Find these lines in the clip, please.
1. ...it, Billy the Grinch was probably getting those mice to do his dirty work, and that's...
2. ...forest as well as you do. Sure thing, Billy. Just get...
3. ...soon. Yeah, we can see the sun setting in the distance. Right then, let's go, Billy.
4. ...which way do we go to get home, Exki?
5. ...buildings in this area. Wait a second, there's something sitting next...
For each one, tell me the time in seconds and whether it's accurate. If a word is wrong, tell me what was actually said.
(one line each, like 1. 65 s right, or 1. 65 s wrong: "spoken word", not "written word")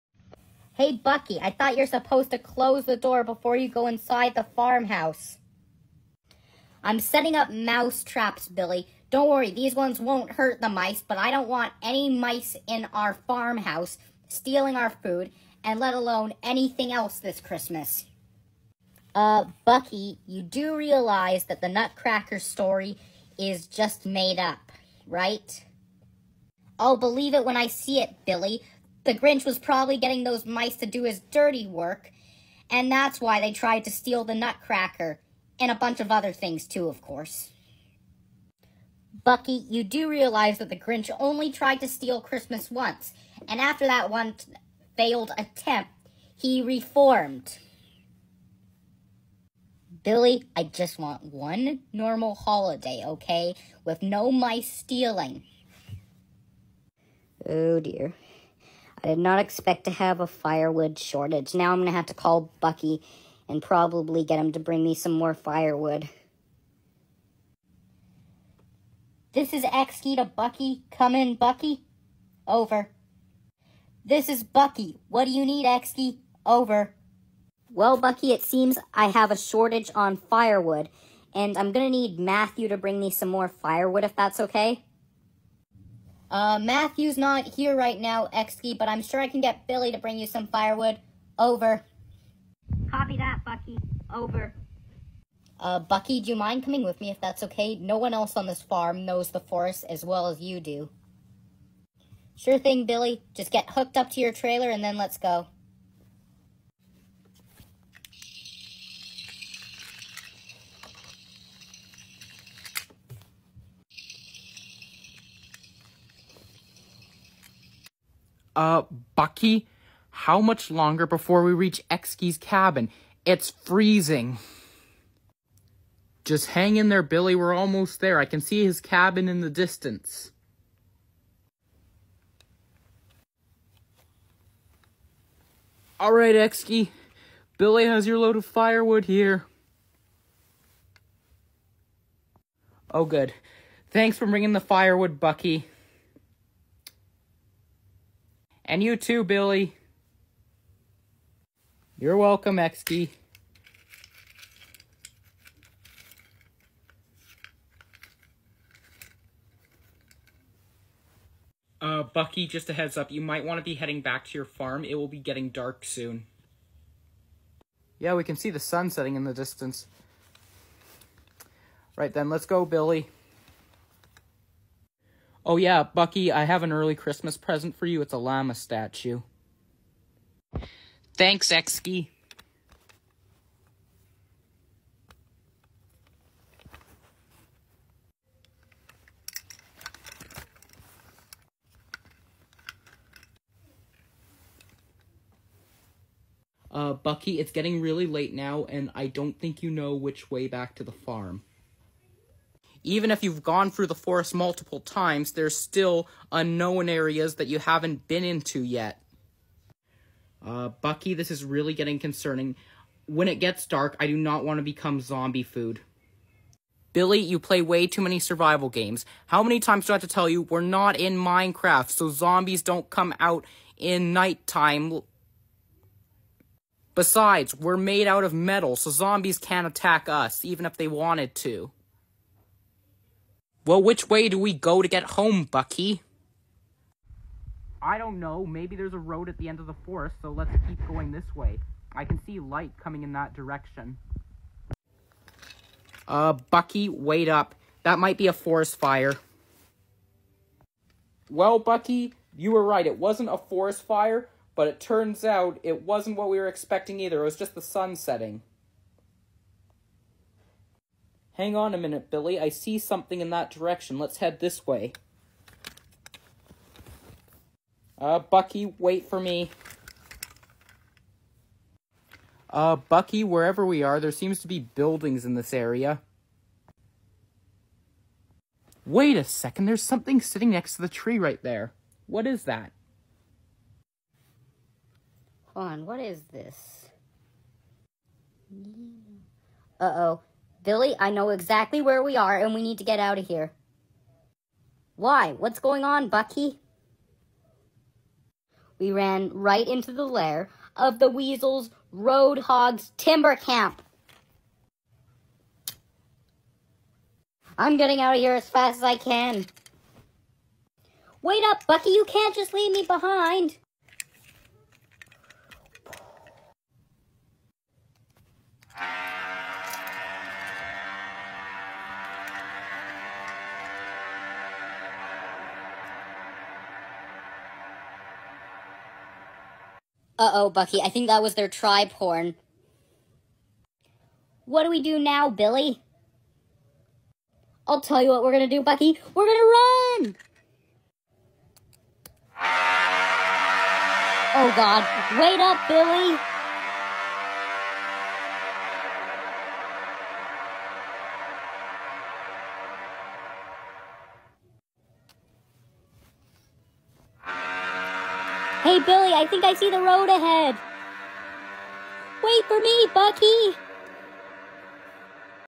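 1. 27 s right
2. 99 s right
3. 165 s right
4. 233 s wrong: "Bucky", not "Exki"
5. 274 s right.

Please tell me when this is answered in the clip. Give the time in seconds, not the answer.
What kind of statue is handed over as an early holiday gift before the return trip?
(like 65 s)
178 s.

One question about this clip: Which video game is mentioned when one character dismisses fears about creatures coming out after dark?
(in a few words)
Minecraft.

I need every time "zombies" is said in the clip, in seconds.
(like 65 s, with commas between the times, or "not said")
215 s, 222 s, 228 s.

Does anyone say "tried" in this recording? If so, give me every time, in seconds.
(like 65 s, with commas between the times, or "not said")
33 s, 41 s.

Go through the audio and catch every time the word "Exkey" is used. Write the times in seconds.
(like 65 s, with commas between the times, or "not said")
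69 s, 75 s.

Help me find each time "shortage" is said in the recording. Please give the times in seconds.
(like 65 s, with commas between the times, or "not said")
60 s, 79 s.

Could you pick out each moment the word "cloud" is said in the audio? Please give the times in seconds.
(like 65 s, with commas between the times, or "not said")
not said.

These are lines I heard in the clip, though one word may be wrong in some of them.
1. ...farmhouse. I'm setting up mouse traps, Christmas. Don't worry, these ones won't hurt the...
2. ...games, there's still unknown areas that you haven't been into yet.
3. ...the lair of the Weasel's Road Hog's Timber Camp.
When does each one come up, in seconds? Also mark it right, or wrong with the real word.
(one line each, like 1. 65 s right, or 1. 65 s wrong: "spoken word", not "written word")
1. 4 s wrong: "Billy", not "Christmas"
2. 204 s wrong: "times", not "games"
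3. 299 s right.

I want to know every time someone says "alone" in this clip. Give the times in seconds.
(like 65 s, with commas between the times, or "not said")
15 s.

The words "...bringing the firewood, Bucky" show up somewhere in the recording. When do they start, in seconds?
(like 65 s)
144 s.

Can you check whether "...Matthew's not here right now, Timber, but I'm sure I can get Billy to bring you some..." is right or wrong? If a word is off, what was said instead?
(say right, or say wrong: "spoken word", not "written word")
wrong: "Exki", not "Timber".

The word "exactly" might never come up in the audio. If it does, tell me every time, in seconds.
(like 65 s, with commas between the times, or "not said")
291 s.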